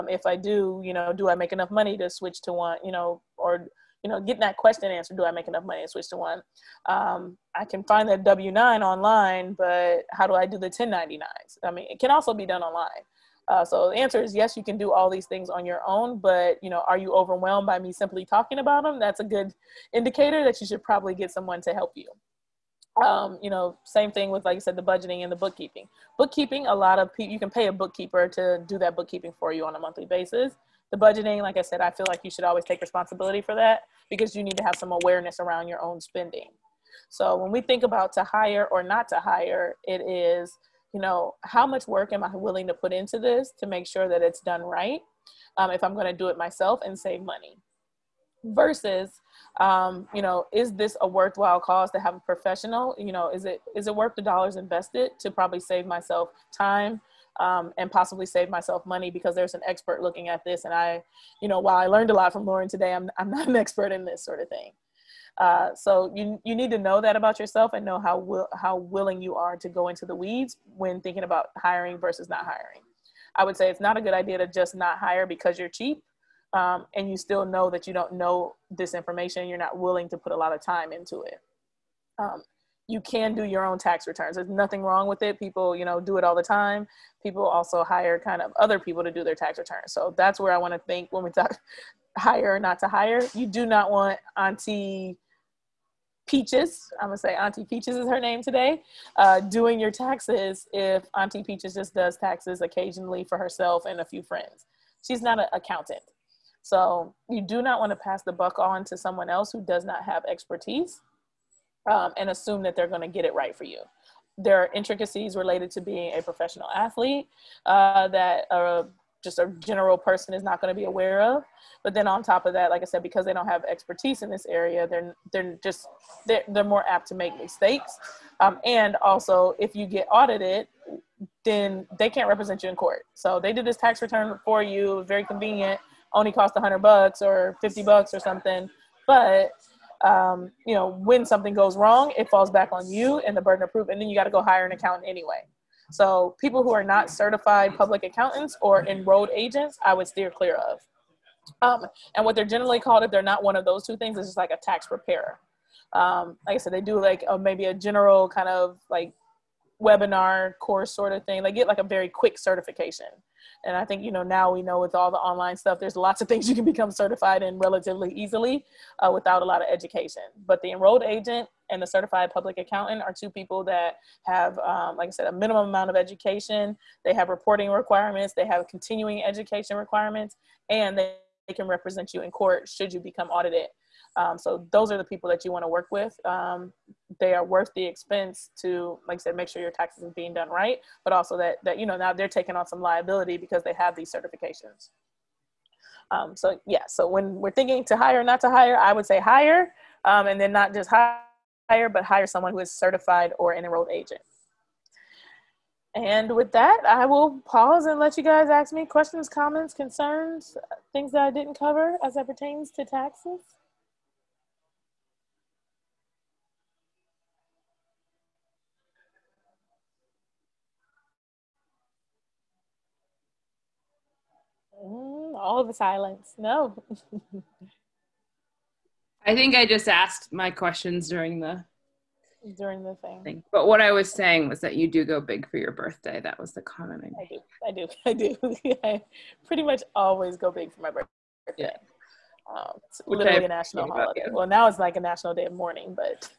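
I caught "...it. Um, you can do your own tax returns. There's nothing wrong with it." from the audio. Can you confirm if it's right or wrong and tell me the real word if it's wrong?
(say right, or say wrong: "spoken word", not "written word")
right.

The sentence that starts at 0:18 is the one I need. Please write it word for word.
That's a good indicator that you should probably get someone to help you.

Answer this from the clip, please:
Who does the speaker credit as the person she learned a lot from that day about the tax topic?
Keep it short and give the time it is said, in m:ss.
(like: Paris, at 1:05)
Lauren, at 1:02.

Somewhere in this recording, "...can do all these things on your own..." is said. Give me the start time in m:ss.
0:14.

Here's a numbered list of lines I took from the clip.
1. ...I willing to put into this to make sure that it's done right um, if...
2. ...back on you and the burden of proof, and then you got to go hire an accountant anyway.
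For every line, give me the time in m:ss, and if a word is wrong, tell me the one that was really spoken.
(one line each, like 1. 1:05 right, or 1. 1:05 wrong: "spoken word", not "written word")
1. 0:42 right
2. 2:22 right.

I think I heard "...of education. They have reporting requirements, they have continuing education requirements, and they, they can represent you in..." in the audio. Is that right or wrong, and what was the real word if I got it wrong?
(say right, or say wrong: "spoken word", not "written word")
right.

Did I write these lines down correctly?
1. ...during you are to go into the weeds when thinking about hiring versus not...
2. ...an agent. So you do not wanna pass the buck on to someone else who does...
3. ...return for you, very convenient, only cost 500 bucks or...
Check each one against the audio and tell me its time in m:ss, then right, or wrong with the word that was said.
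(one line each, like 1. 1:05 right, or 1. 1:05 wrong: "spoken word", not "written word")
1. 1:08 wrong: "willing", not "during"
2. 1:45 wrong: "accountant", not "agent"
3. 2:14 wrong: "100", not "500".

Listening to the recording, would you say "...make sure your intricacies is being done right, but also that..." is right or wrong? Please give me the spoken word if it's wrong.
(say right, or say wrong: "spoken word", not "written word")
wrong: "taxes", not "intricacies".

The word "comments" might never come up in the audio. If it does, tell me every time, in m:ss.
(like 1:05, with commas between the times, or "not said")
3:29, 3:56.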